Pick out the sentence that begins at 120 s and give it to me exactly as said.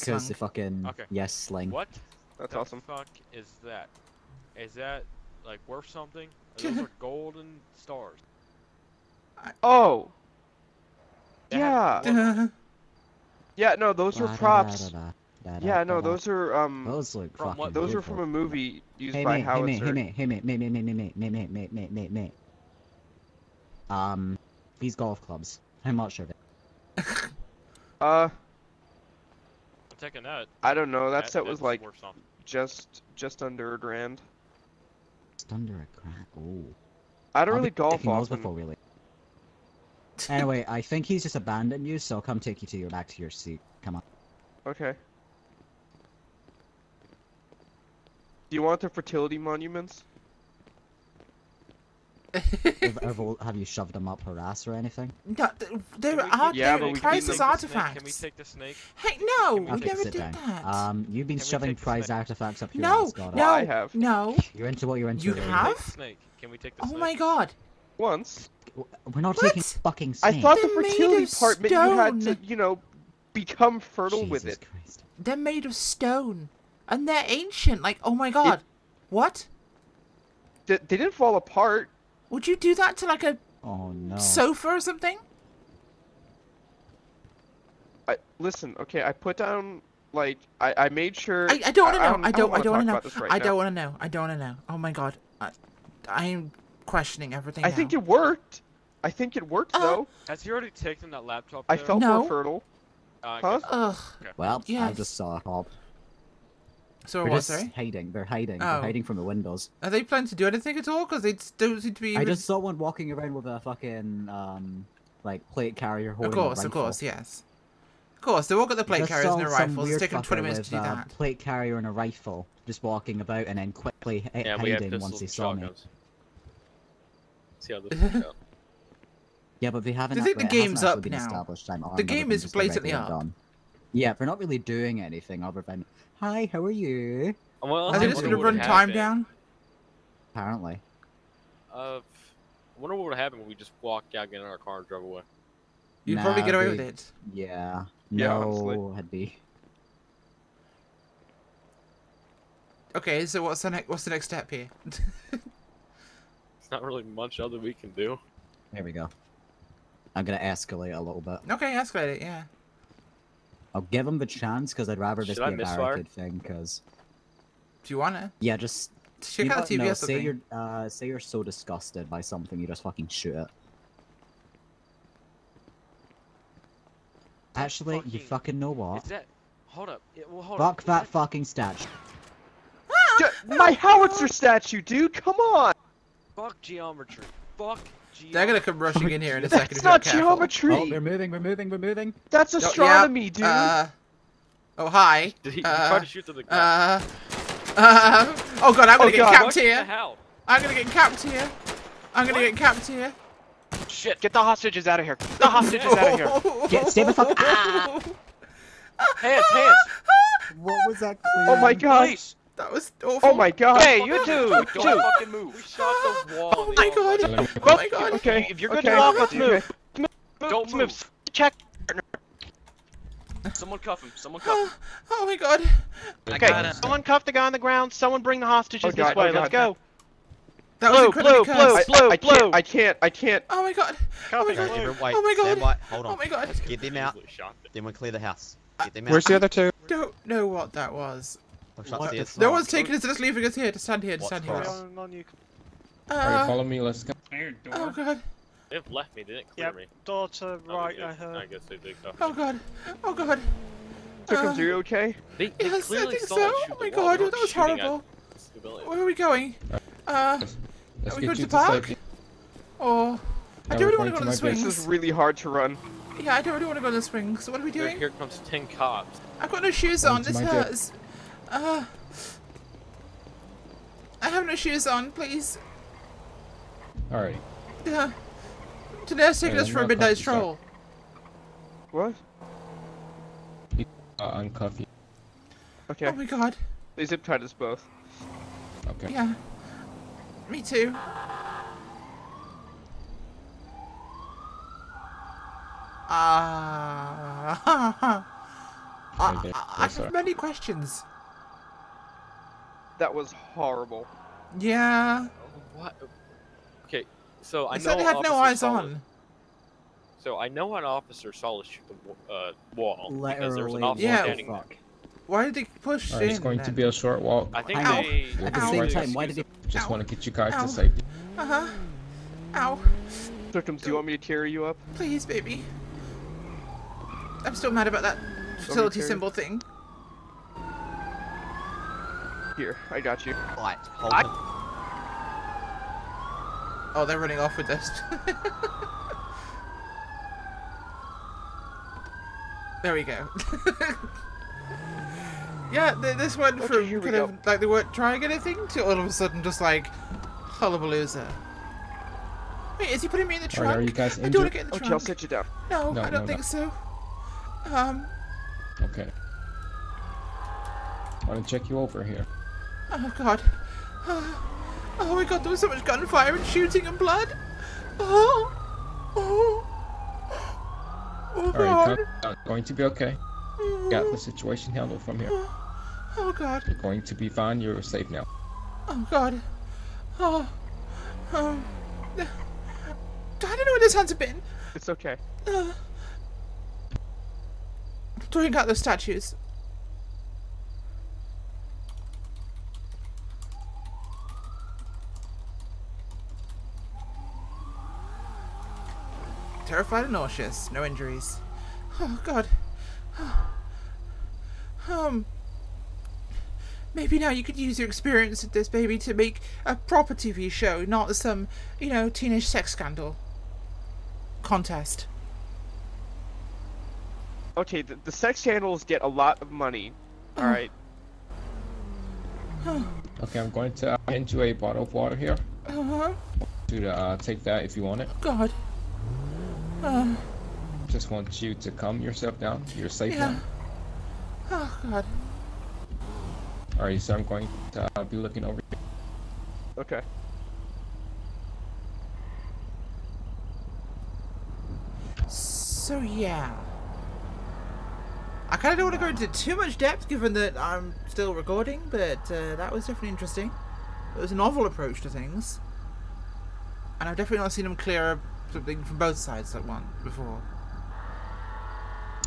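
Uh, plate carrier and a rifle just walking about and then quickly yeah, hiding once they saw shotguns.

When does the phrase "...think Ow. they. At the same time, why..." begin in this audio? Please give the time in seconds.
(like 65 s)
317 s.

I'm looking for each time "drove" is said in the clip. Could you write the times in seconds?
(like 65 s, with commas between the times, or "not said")
144 s.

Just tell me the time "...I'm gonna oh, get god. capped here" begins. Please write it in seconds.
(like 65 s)
198 s.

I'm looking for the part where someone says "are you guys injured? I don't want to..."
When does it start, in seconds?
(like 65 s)
353 s.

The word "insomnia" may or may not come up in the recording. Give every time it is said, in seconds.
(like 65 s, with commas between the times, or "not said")
not said.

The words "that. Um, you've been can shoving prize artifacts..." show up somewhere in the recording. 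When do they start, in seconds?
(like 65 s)
60 s.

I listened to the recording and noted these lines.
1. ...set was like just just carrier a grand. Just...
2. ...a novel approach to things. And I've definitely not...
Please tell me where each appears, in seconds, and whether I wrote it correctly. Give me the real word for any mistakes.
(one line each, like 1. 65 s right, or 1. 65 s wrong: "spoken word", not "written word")
1. 31 s wrong: "under", not "carrier"
2. 454 s right.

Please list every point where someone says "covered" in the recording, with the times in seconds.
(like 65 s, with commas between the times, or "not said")
not said.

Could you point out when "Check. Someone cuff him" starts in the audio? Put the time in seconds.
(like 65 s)
221 s.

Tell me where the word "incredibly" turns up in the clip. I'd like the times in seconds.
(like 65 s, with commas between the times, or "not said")
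231 s.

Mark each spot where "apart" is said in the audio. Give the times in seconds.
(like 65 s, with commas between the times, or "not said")
81 s.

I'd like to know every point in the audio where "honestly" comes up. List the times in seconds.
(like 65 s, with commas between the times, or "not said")
148 s.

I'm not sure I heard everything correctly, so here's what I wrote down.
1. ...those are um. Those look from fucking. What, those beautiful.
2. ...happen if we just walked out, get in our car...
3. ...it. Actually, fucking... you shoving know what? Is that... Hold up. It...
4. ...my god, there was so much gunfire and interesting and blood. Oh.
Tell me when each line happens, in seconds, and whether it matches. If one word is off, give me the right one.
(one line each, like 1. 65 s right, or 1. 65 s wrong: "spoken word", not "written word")
1. 16 s right
2. 143 s right
3. 173 s wrong: "fucking", not "shoving"
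4. 365 s wrong: "shooting", not "interesting".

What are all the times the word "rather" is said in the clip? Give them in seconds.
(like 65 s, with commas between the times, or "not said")
164 s.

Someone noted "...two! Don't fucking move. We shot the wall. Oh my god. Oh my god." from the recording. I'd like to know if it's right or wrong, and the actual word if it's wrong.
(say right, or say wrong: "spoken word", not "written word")
right.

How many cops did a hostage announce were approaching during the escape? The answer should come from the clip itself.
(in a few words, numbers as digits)
10.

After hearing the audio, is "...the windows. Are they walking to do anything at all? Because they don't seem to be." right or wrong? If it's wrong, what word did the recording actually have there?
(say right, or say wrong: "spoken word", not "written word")
wrong: "planning", not "walking".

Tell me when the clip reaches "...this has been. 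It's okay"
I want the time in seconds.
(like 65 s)
383 s.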